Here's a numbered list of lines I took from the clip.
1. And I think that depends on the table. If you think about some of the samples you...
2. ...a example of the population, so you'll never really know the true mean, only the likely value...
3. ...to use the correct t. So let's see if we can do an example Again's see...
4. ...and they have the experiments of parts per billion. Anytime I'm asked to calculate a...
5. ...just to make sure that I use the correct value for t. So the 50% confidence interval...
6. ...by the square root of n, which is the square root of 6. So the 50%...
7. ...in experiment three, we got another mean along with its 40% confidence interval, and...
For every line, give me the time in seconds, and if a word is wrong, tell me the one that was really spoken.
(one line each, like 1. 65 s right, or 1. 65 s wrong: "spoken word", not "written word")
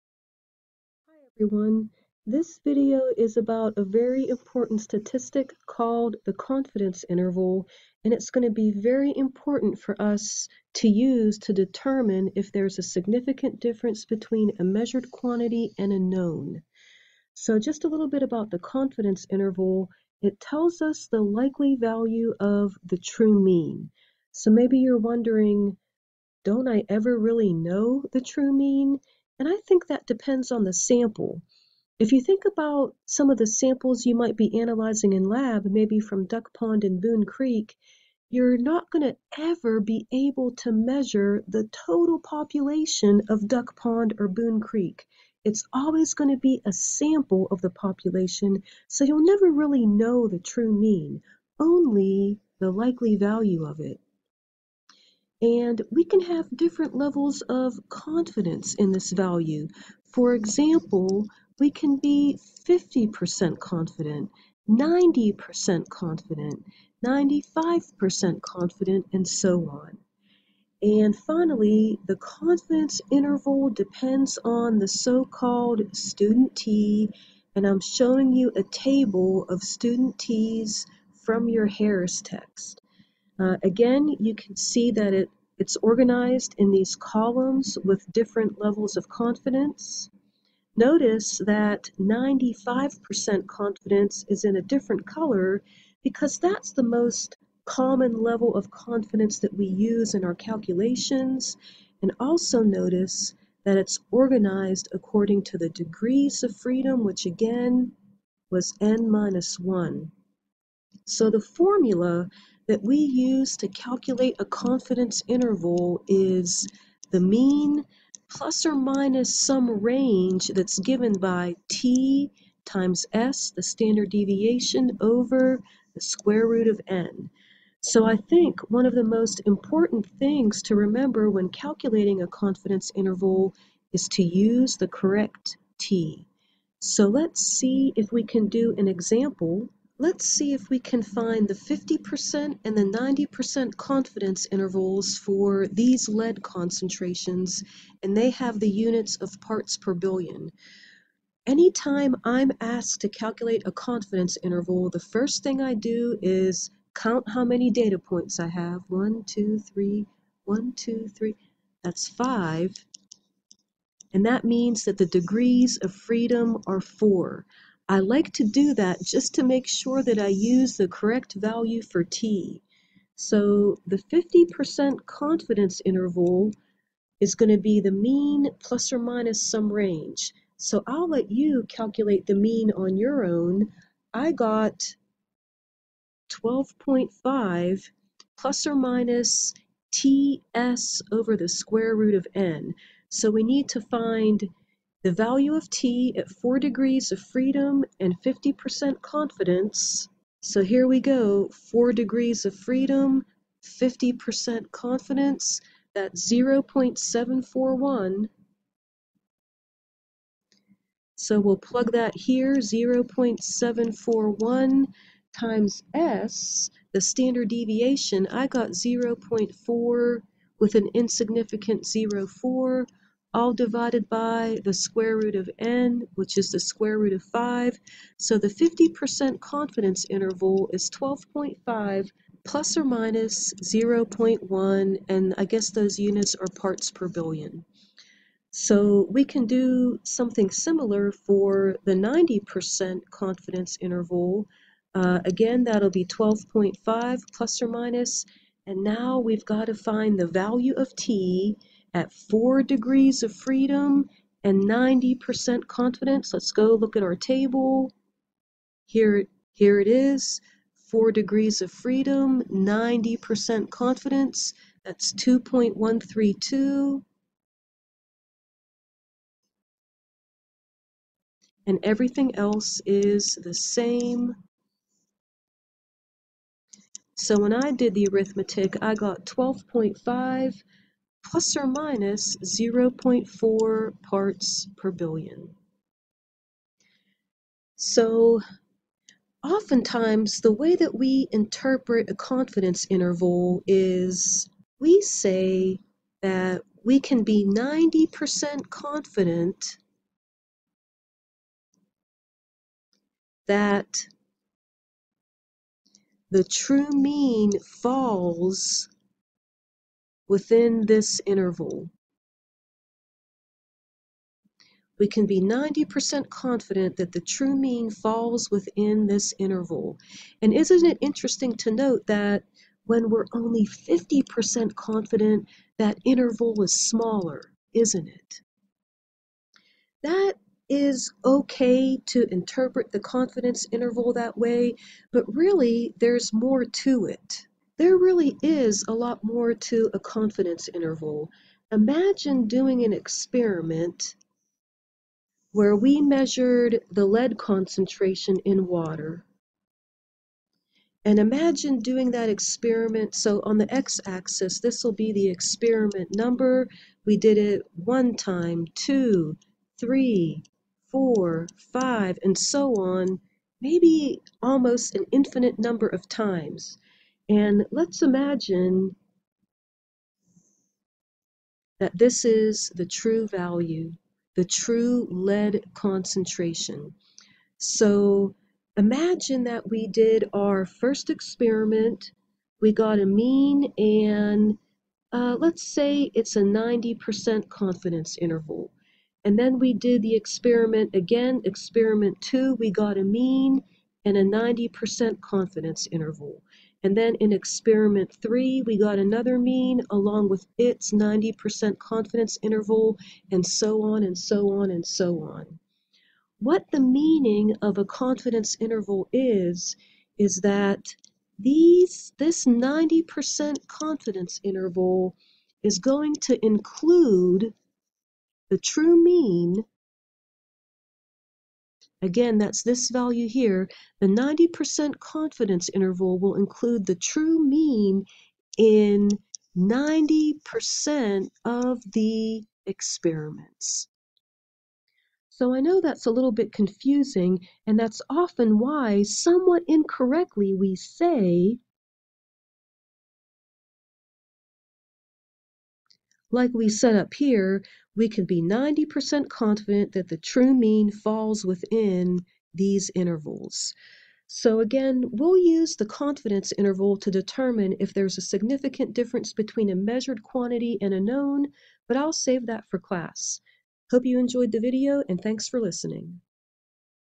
1. 29 s wrong: "sample", not "table"
2. 46 s wrong: "sample", not "example"
3. 134 s wrong: "Let", not "Again"
4. 148 s wrong: "units", not "experiments"
5. 169 s right
6. 224 s wrong: "5", not "6"
7. 397 s wrong: "90", not "40".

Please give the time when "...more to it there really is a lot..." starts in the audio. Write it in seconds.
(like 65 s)
336 s.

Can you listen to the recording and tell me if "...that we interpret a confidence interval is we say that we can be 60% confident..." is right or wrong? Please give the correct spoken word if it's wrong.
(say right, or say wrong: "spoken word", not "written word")
wrong: "90", not "60".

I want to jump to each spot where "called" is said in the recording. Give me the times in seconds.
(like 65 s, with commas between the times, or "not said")
5 s, 74 s.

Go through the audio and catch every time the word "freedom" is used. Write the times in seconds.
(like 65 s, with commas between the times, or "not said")
106 s, 165 s, 197 s, 202 s, 253 s, 261 s.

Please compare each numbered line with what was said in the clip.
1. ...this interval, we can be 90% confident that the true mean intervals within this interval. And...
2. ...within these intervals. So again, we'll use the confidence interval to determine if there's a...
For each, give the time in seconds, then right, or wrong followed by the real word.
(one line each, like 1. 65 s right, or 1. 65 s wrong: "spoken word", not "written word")
1. 310 s wrong: "falls", not "intervals"
2. 451 s right.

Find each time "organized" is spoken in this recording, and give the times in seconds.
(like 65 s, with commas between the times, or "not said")
85 s, 104 s.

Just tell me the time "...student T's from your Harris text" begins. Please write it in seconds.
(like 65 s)
79 s.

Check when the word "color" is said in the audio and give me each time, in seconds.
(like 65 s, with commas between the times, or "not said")
95 s.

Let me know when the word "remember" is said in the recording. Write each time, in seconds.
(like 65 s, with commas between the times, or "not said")
130 s.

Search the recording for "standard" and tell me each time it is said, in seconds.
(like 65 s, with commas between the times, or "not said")
123 s, 217 s.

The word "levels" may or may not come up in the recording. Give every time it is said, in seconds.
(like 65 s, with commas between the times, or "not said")
56 s, 88 s, 98 s.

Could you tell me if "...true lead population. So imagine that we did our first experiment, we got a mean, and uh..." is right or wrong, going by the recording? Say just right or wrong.
wrong.